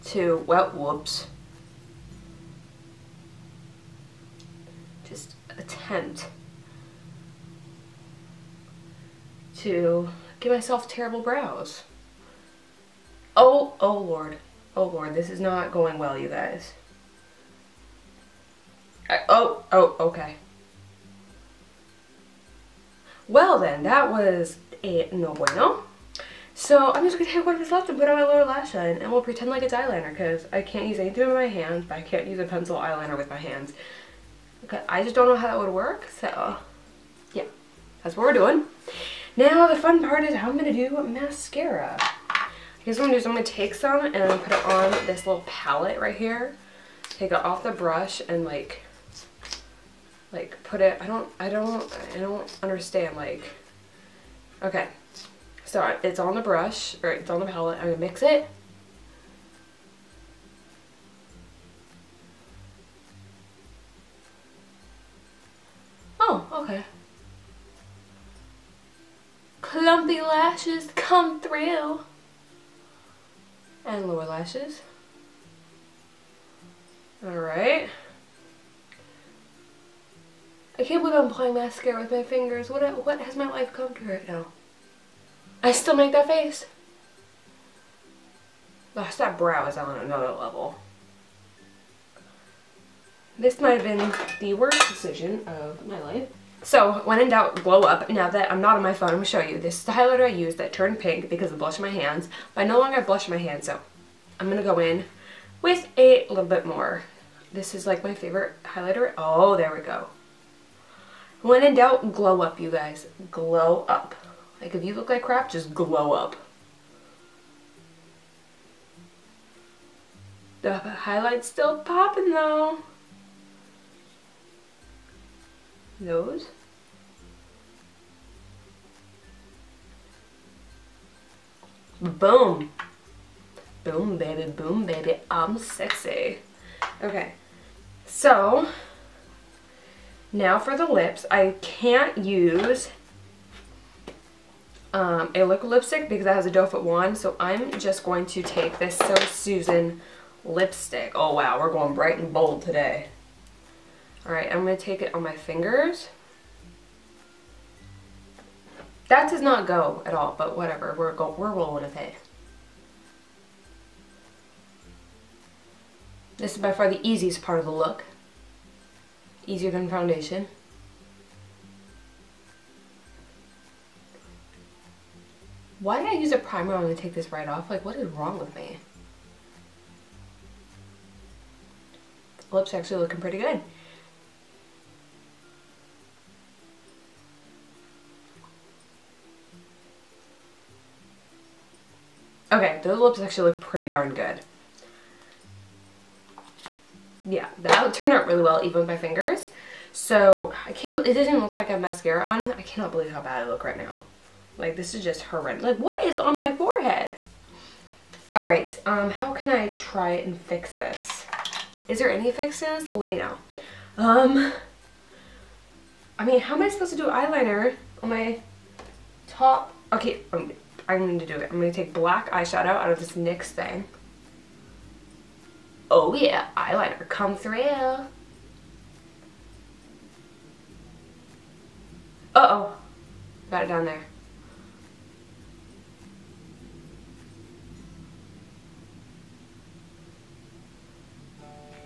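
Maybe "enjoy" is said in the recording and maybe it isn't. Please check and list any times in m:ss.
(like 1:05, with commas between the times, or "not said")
not said.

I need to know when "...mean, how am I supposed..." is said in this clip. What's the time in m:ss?
3:36.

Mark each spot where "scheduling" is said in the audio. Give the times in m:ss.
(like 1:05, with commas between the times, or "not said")
not said.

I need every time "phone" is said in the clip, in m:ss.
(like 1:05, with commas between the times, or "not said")
1:38.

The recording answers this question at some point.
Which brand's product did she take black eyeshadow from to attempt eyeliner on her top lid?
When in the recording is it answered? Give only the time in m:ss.
3:43.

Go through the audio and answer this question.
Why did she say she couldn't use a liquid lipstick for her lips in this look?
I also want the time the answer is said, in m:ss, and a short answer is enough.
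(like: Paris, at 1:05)
Doe foot wand, at 2:26.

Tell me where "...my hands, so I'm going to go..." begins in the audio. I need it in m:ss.
1:43.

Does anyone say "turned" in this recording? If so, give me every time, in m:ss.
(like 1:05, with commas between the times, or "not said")
1:40, 3:17.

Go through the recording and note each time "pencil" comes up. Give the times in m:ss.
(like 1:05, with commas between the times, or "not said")
0:32.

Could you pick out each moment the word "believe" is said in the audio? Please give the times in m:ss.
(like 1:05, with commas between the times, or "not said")
1:21, 3:22.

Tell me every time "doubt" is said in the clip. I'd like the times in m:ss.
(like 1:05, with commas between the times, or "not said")
1:37, 1:51.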